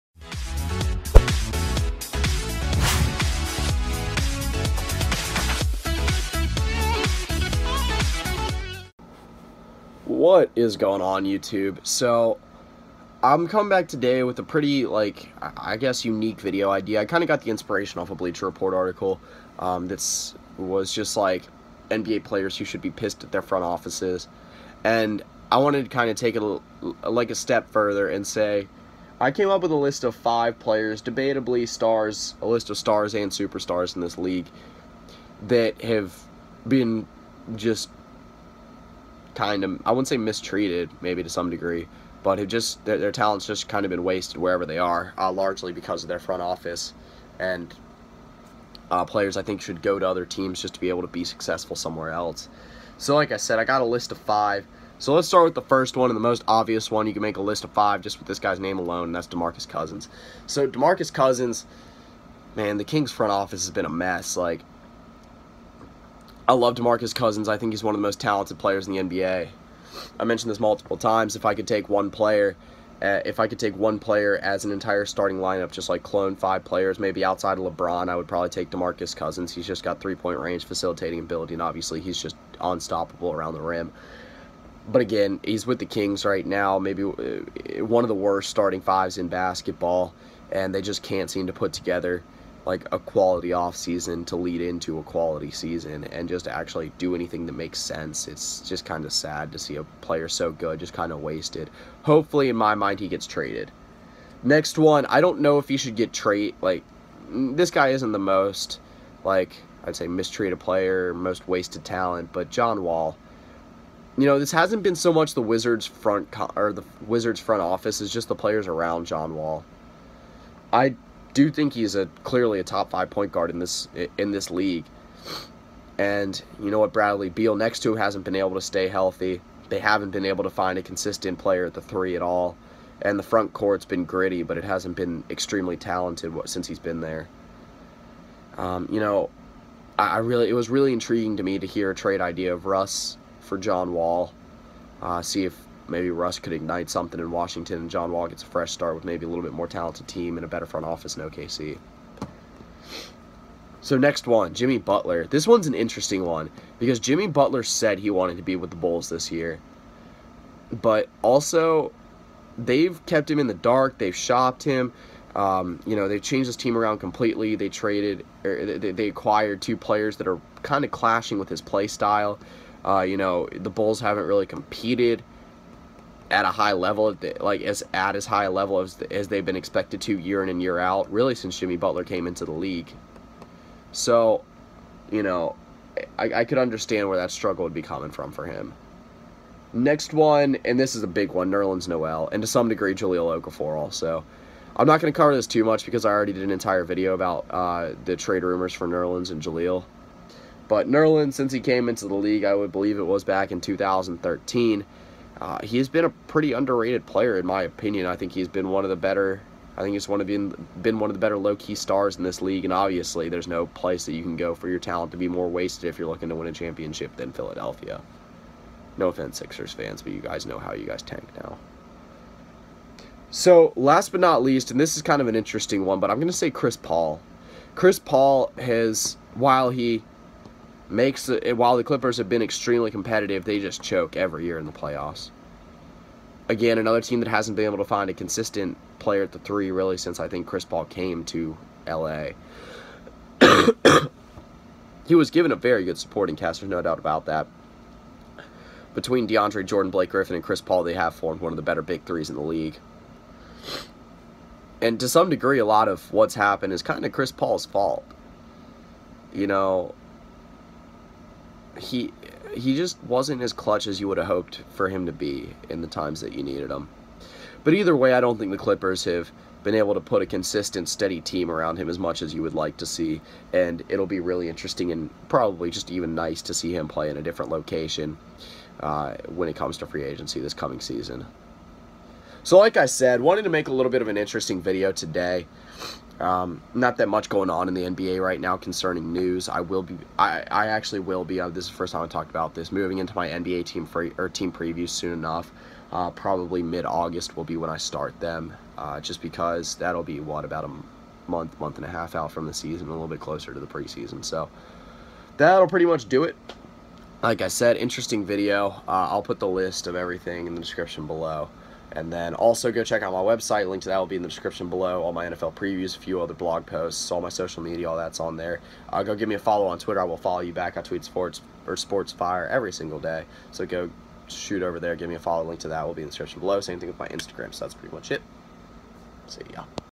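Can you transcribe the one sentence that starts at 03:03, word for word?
So, you know, I, I could understand where that struggle would be coming from for him.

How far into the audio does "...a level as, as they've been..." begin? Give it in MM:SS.
02:58.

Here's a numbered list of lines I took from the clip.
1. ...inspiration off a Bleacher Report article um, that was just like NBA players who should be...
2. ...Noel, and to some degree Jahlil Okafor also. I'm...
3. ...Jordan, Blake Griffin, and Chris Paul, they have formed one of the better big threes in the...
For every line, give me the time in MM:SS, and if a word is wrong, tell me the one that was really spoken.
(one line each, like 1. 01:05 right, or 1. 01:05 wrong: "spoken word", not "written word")
1. 00:17 right
2. 03:11 right
3. 04:09 right.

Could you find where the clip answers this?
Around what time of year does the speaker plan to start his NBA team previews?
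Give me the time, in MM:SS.
04:56.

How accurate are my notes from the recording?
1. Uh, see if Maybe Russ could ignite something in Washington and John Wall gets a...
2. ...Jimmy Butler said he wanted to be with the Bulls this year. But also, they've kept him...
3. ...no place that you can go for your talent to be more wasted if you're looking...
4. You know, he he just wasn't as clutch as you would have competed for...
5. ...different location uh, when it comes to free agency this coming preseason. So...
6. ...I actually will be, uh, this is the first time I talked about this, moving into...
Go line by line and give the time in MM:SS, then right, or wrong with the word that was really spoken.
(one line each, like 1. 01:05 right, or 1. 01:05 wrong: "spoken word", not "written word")
1. 02:25 right
2. 02:36 right
3. 03:33 right
4. 04:19 wrong: "hoped", not "competed"
5. 04:37 wrong: "season", not "preseason"
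6. 04:50 right.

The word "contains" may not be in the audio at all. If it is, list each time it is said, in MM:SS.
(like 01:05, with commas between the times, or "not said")
not said.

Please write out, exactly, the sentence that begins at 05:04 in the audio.
So that'll pretty much do it.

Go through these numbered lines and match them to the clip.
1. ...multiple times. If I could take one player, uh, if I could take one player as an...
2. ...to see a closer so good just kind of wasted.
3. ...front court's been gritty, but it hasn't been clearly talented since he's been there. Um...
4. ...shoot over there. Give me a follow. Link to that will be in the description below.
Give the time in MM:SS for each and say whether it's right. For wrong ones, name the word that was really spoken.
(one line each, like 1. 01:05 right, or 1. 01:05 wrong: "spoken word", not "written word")
1. 01:10 right
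2. 01:39 wrong: "player", not "closer"
3. 02:13 wrong: "extremely", not "clearly"
4. 05:24 right.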